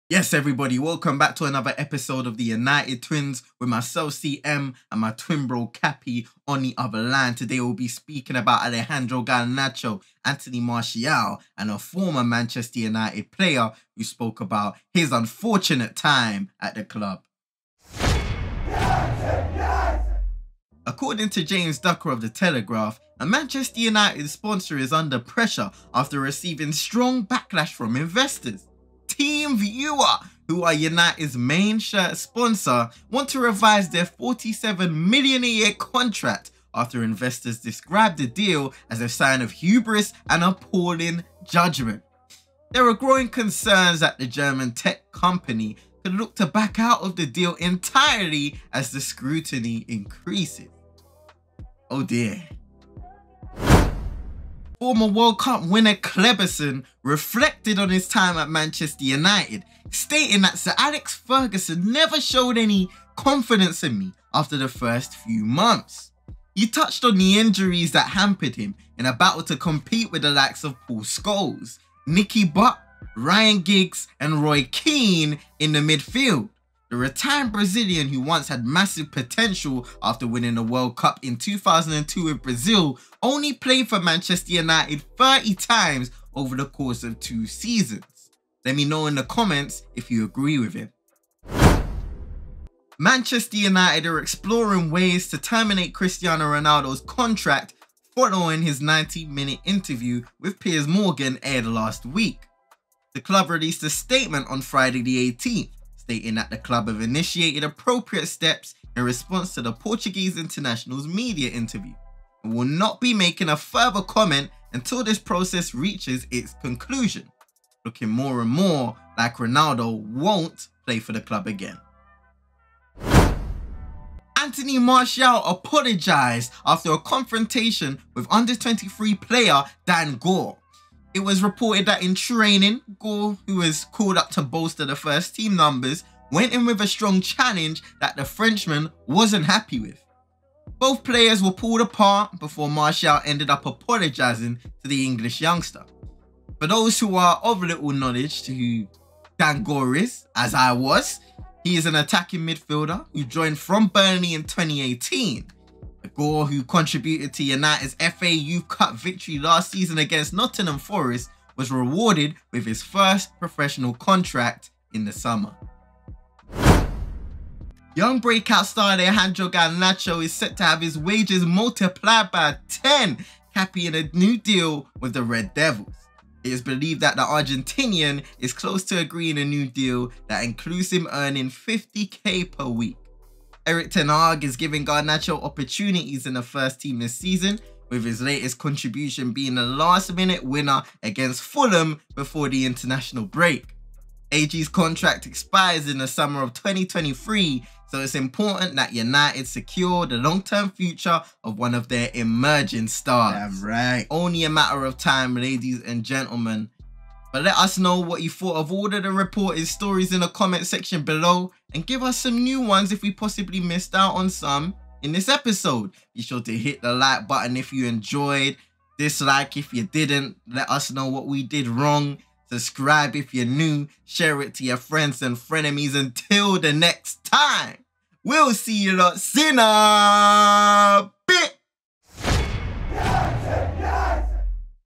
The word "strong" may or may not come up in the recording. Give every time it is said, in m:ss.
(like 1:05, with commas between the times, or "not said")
0:26, 2:16.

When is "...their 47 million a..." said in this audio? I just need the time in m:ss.
0:33.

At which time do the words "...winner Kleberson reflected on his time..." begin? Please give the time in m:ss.
0:55.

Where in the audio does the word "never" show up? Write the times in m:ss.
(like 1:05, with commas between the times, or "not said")
1:01.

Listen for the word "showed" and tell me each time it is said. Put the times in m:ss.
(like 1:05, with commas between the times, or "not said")
1:02.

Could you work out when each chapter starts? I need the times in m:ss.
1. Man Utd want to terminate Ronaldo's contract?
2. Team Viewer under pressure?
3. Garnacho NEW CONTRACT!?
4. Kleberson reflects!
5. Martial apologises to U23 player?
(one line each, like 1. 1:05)
1. 1:32
2. 0:20
3. 2:47
4. 0:54
5. 2:04.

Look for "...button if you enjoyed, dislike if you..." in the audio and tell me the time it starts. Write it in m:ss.
3:37.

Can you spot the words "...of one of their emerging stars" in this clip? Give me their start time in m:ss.
3:21.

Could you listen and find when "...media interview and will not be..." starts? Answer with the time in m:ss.
1:51.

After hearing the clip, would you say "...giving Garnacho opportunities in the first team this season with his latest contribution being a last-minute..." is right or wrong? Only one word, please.
right.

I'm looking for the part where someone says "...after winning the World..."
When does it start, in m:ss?
1:20.